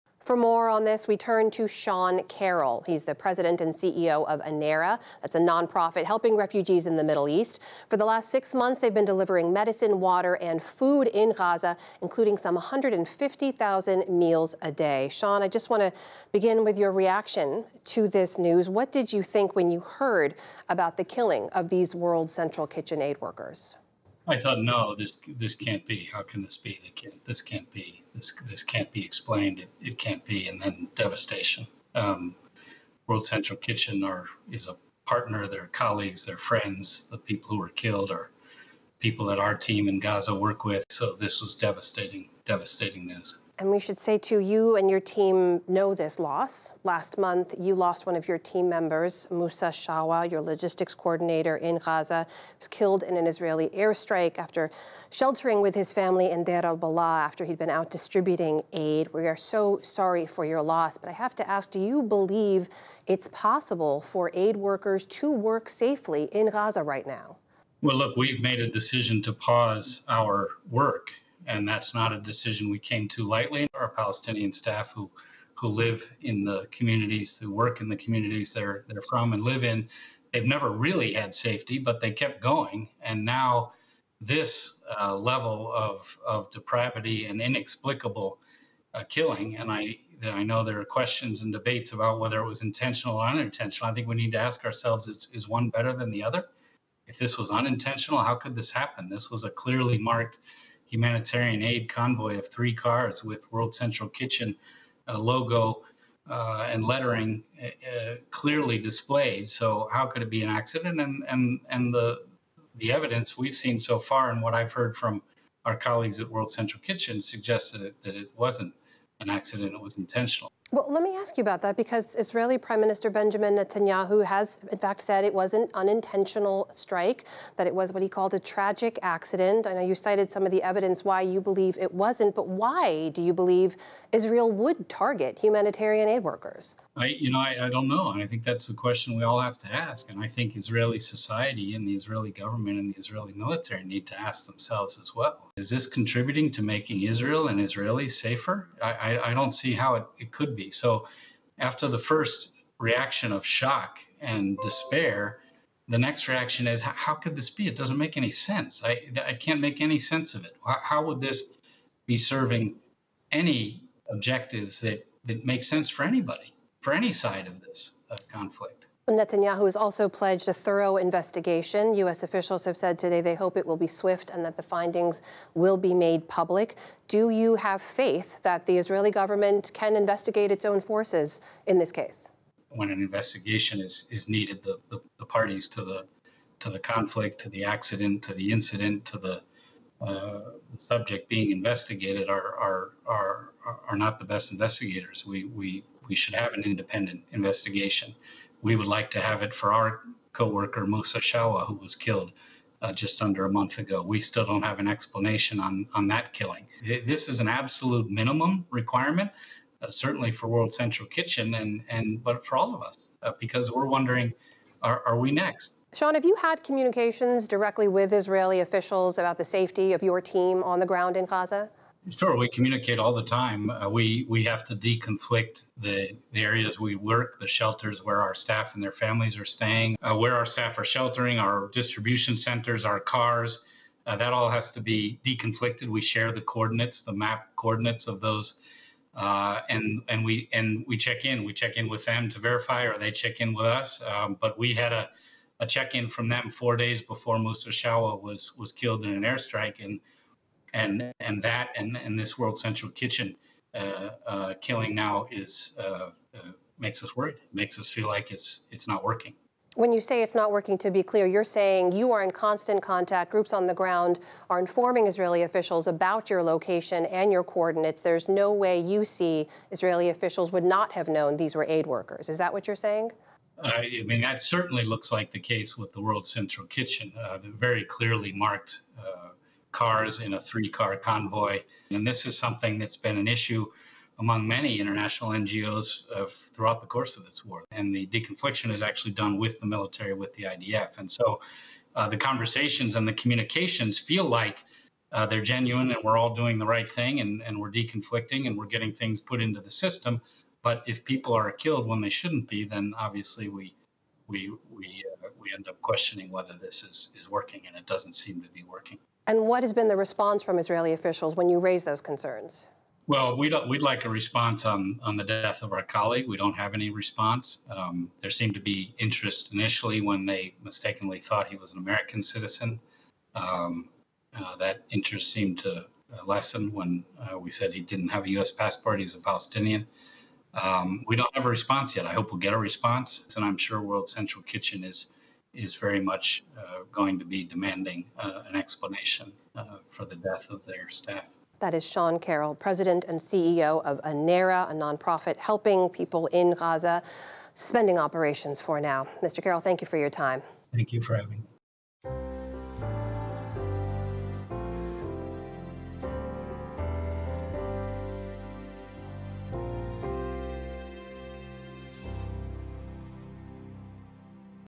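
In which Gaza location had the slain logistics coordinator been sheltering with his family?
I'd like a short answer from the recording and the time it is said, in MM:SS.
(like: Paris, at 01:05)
Deir al-Balah, at 00:56.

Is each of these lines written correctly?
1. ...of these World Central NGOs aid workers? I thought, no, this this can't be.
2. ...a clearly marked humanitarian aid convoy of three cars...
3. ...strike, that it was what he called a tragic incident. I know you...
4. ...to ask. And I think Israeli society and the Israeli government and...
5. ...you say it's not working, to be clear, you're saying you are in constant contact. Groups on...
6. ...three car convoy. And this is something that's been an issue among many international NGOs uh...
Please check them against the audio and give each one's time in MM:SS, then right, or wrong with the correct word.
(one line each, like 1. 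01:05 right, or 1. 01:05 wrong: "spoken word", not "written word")
1. 00:21 wrong: "Kitchen", not "NGOs"
2. 01:39 right
3. 02:06 wrong: "accident", not "incident"
4. 02:19 right
5. 04:19 right
6. 04:40 right.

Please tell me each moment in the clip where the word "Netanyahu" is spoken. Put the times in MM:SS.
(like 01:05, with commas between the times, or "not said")
02:03, 02:49.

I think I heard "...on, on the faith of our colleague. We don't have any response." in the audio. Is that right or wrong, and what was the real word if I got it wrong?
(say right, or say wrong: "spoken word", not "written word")
wrong: "death", not "faith".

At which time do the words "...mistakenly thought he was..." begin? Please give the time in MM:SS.
05:20.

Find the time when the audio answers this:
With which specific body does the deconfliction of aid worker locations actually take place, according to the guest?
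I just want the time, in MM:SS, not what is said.
04:50.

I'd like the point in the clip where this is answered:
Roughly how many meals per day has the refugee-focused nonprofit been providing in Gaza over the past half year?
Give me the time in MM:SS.
00:12.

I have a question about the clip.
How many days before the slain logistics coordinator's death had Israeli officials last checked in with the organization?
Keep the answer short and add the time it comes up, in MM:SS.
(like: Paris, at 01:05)
4, at 04:06.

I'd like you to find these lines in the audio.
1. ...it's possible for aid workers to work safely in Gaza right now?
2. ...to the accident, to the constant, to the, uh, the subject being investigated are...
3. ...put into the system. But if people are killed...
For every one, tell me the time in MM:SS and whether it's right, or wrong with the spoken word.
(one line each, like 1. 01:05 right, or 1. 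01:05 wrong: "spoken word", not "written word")
1. 01:03 right
2. 03:07 wrong: "incident", not "constant"
3. 04:59 right.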